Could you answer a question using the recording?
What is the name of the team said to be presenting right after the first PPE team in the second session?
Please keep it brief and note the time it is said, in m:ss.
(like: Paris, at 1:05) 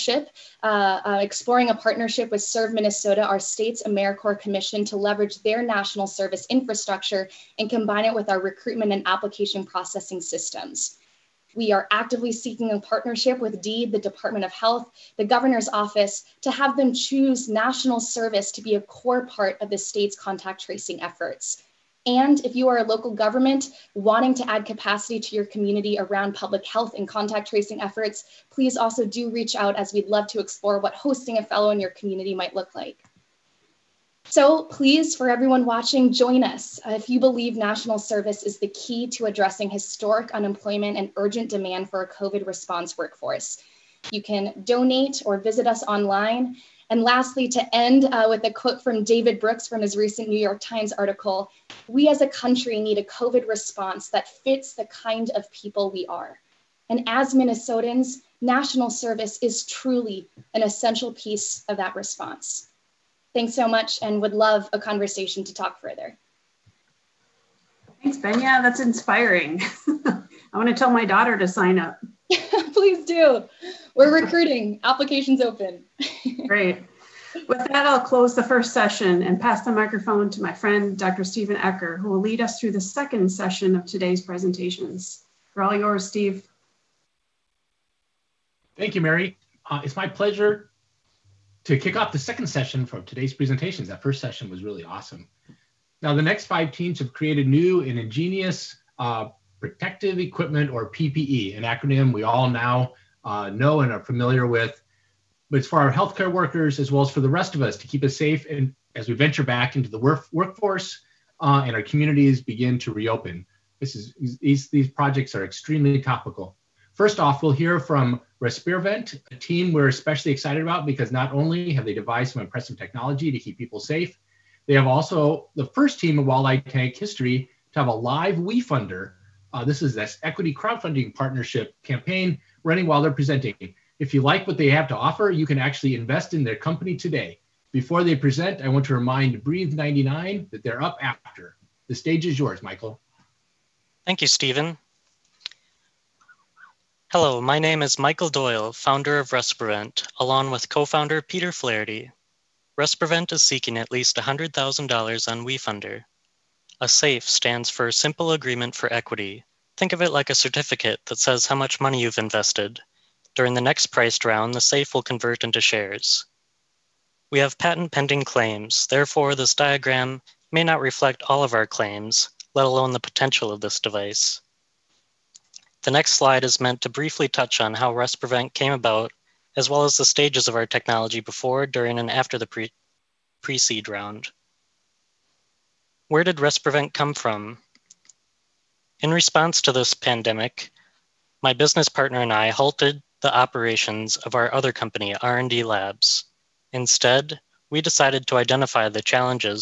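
Breathe 99, at 2:19.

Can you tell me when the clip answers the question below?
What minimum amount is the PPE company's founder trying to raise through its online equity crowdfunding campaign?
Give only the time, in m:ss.
2:34.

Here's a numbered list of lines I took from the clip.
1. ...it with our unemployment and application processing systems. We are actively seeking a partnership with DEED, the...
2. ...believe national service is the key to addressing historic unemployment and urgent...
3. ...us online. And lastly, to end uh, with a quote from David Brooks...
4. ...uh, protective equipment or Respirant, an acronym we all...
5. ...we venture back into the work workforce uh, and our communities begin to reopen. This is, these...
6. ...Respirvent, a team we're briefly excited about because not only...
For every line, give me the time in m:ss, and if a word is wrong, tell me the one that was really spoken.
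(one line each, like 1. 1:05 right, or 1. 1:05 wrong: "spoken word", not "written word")
1. 0:08 wrong: "recruitment", not "unemployment"
2. 0:37 right
3. 0:45 right
4. 1:38 wrong: "PPE", not "Respirant"
5. 1:49 right
6. 1:58 wrong: "especially", not "briefly".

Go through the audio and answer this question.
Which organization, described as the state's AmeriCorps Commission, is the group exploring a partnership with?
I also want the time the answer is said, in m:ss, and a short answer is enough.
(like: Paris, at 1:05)
Serve Minnesota, at 0:02.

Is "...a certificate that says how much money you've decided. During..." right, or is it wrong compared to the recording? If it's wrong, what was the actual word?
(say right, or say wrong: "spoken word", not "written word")
wrong: "invested", not "decided".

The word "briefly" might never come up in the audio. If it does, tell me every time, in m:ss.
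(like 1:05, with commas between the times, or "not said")
2:56.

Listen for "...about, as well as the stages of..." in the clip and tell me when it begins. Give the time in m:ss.
2:58.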